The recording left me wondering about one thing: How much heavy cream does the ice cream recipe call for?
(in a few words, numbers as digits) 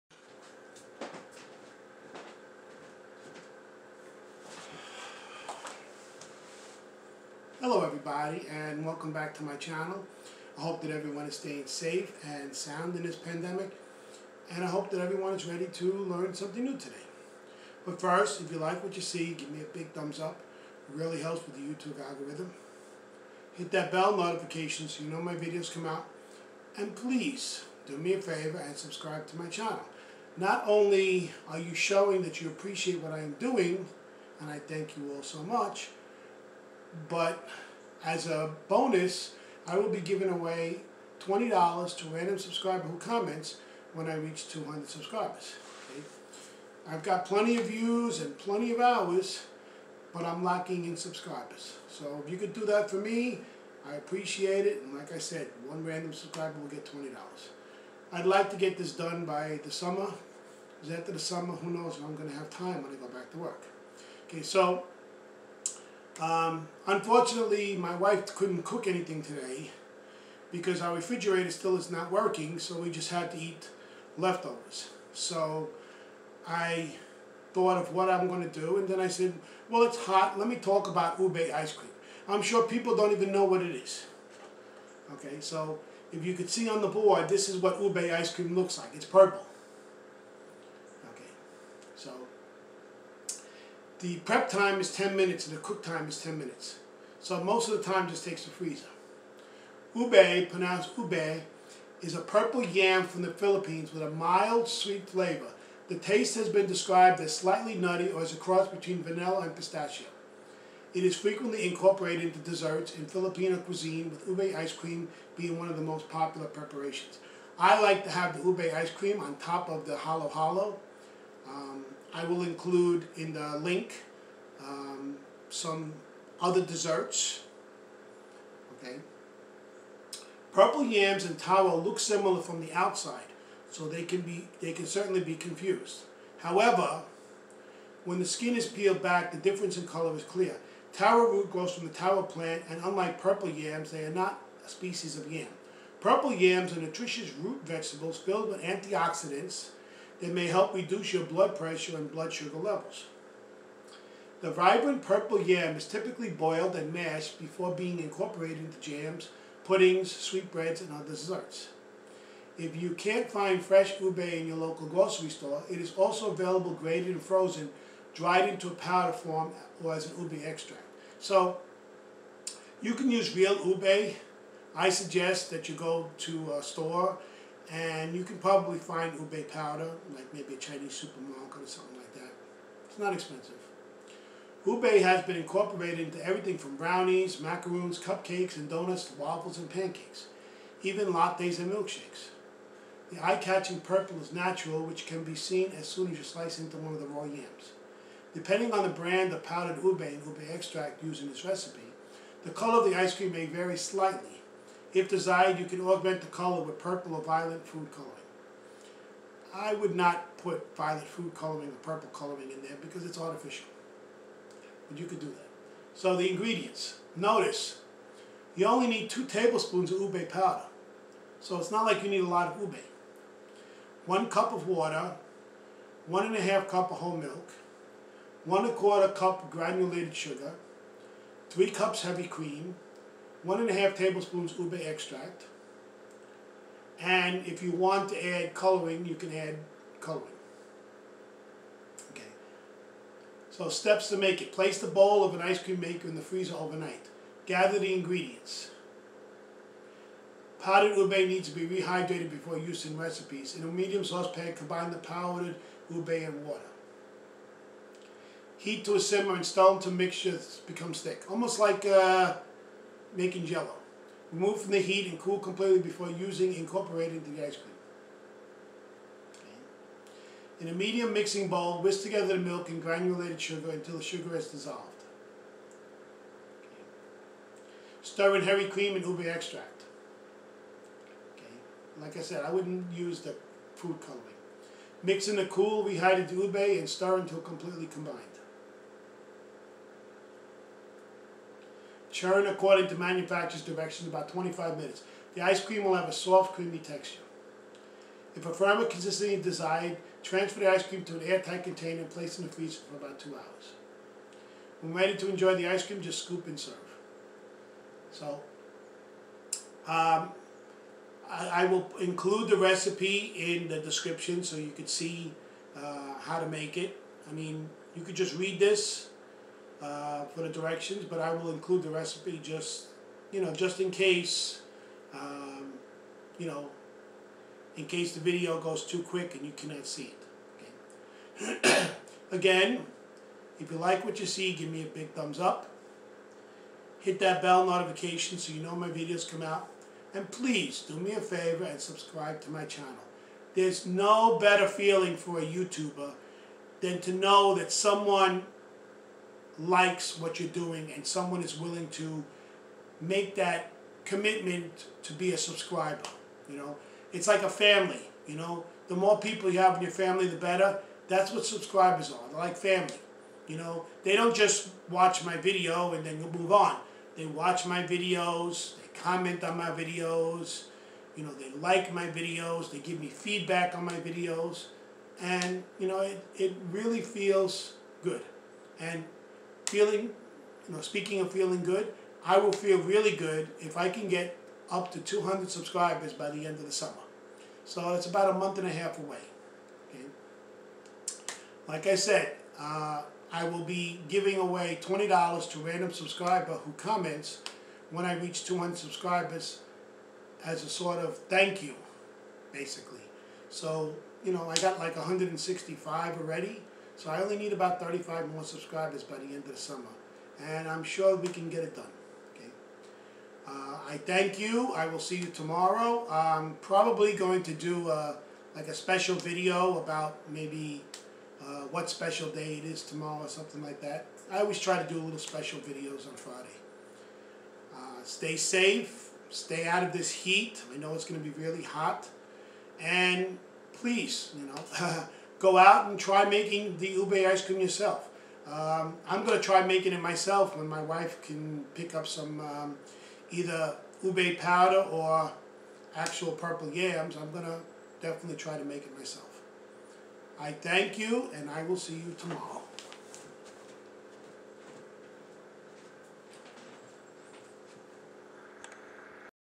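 3 cups.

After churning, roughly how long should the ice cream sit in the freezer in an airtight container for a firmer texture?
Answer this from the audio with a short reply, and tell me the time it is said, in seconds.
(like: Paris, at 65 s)
2 hours, at 303 s.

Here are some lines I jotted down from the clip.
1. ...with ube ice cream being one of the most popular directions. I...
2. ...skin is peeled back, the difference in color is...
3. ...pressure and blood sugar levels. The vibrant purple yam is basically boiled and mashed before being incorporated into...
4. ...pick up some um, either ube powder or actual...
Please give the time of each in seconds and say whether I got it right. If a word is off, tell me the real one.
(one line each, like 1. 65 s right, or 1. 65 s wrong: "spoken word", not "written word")
1. 114 s wrong: "preparations", not "directions"
2. 138 s right
3. 151 s wrong: "typically", not "basically"
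4. 441 s right.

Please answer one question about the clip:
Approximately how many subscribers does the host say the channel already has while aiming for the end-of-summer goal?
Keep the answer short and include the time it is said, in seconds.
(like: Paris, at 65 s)
165, at 404 s.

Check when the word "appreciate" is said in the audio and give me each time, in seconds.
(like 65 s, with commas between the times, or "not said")
32 s, 53 s.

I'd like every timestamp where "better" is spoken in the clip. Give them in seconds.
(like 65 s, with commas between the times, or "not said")
344 s, 360 s.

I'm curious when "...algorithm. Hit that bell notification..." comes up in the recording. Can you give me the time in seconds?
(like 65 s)
22 s.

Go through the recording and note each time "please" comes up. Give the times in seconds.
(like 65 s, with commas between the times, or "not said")
26 s, 340 s, 433 s.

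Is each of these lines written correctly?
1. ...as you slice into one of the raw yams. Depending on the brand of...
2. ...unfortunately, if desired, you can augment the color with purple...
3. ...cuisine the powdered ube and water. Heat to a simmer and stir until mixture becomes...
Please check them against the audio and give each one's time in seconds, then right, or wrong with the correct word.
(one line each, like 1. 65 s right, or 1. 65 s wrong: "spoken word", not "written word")
1. 196 s right
2. 203 s wrong: "slightly", not "unfortunately"
3. 254 s wrong: "combine", not "cuisine".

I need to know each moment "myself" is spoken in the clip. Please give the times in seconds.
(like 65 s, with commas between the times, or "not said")
440 s, 448 s.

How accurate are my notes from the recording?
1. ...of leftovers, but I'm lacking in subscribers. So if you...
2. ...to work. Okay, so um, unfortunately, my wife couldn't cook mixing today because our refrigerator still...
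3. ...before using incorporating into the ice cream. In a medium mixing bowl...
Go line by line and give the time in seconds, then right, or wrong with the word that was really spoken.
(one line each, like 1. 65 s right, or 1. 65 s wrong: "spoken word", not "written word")
1. 48 s wrong: "hours", not "leftovers"
2. 63 s wrong: "anything", not "mixing"
3. 265 s right.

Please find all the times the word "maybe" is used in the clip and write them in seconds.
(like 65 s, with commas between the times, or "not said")
180 s, 420 s.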